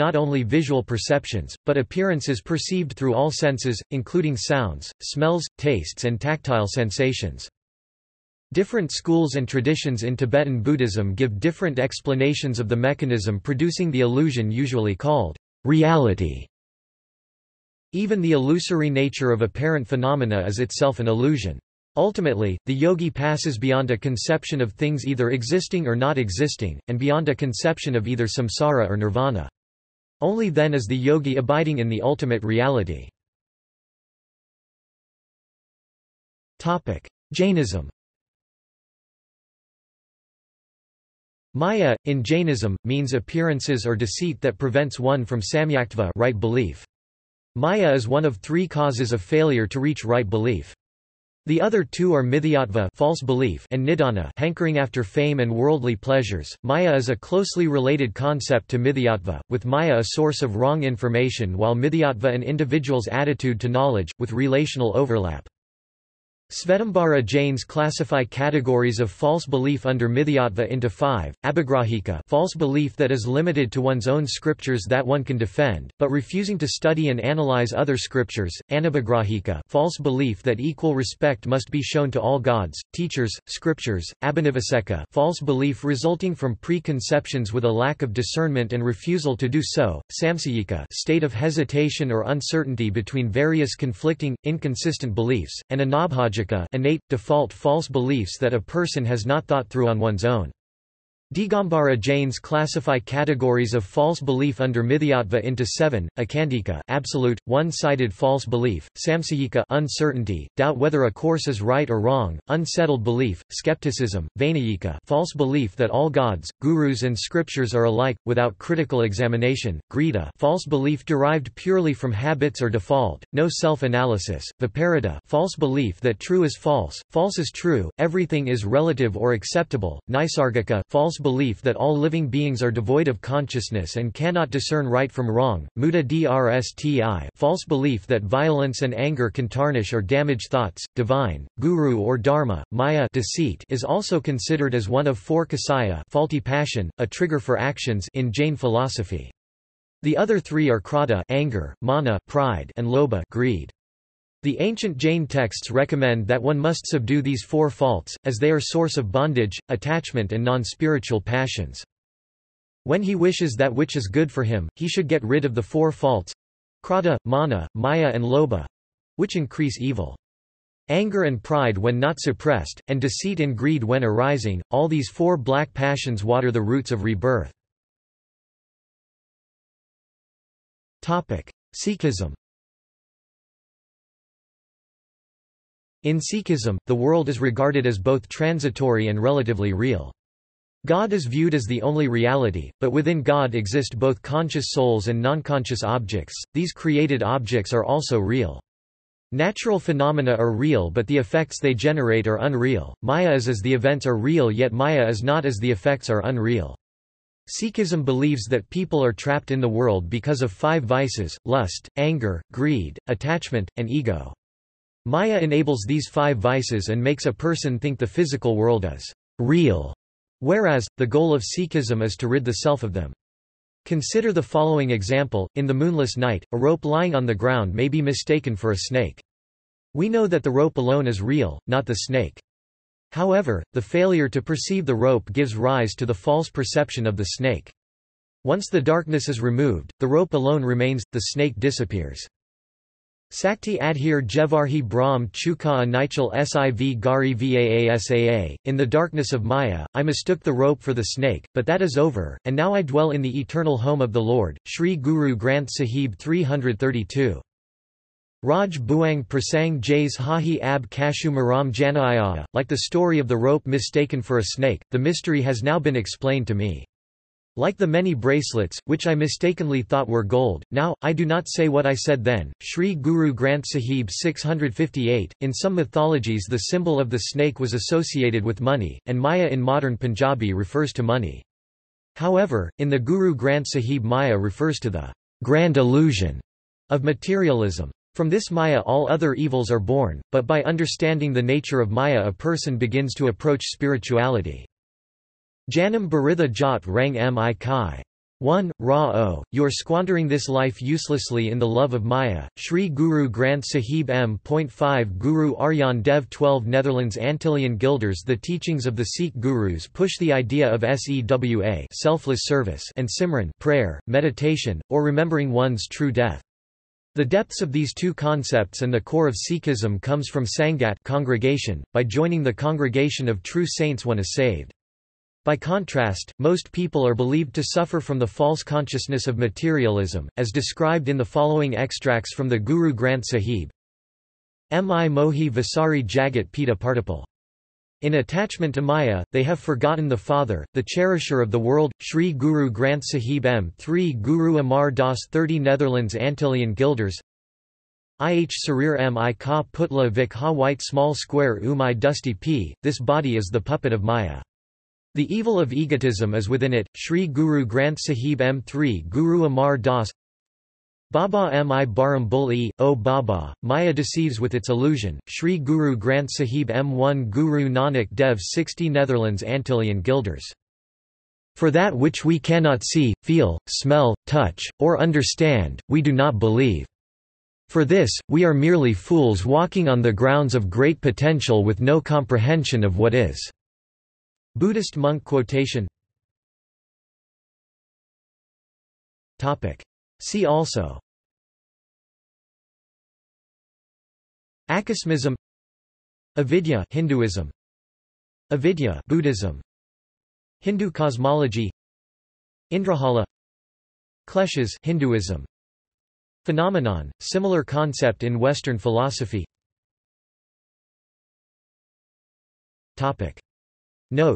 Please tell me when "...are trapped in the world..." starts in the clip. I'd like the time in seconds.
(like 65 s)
209 s.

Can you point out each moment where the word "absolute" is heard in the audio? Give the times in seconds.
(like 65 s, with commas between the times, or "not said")
106 s.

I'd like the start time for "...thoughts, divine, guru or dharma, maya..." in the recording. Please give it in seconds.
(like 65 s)
140 s.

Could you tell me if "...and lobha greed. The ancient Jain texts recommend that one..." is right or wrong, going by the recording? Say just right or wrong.
right.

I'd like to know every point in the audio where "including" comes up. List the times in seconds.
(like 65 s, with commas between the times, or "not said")
3 s.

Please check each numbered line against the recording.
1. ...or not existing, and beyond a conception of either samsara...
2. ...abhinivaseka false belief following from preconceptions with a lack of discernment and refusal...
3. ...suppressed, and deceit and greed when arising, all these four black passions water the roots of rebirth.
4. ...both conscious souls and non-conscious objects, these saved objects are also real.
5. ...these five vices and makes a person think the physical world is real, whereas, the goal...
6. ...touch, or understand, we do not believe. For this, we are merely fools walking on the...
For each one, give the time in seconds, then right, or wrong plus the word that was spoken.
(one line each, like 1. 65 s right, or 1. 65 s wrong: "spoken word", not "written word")
1. 25 s right
2. 84 s wrong: "resulting", not "following"
3. 172 s right
4. 193 s wrong: "created", not "saved"
5. 215 s right
6. 374 s right.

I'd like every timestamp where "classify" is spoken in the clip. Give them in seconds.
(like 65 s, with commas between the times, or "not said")
67 s, 102 s.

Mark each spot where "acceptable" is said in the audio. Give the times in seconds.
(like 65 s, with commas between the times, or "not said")
129 s.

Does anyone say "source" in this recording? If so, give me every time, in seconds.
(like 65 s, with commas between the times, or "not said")
60 s, 158 s.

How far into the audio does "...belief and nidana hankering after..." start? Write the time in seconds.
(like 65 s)
53 s.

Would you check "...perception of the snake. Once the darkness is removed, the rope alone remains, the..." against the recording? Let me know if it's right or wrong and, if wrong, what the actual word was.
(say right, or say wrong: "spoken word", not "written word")
right.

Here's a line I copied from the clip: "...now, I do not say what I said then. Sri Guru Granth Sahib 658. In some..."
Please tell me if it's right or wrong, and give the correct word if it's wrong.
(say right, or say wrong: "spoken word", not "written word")
right.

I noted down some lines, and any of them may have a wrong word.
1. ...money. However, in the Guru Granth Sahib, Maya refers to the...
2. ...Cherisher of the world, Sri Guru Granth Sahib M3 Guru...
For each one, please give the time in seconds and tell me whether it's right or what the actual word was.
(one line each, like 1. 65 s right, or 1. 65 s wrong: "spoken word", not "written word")
1. 281 s right
2. 340 s right.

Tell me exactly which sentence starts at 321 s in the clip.
By joining the congregation of true saints one is saved.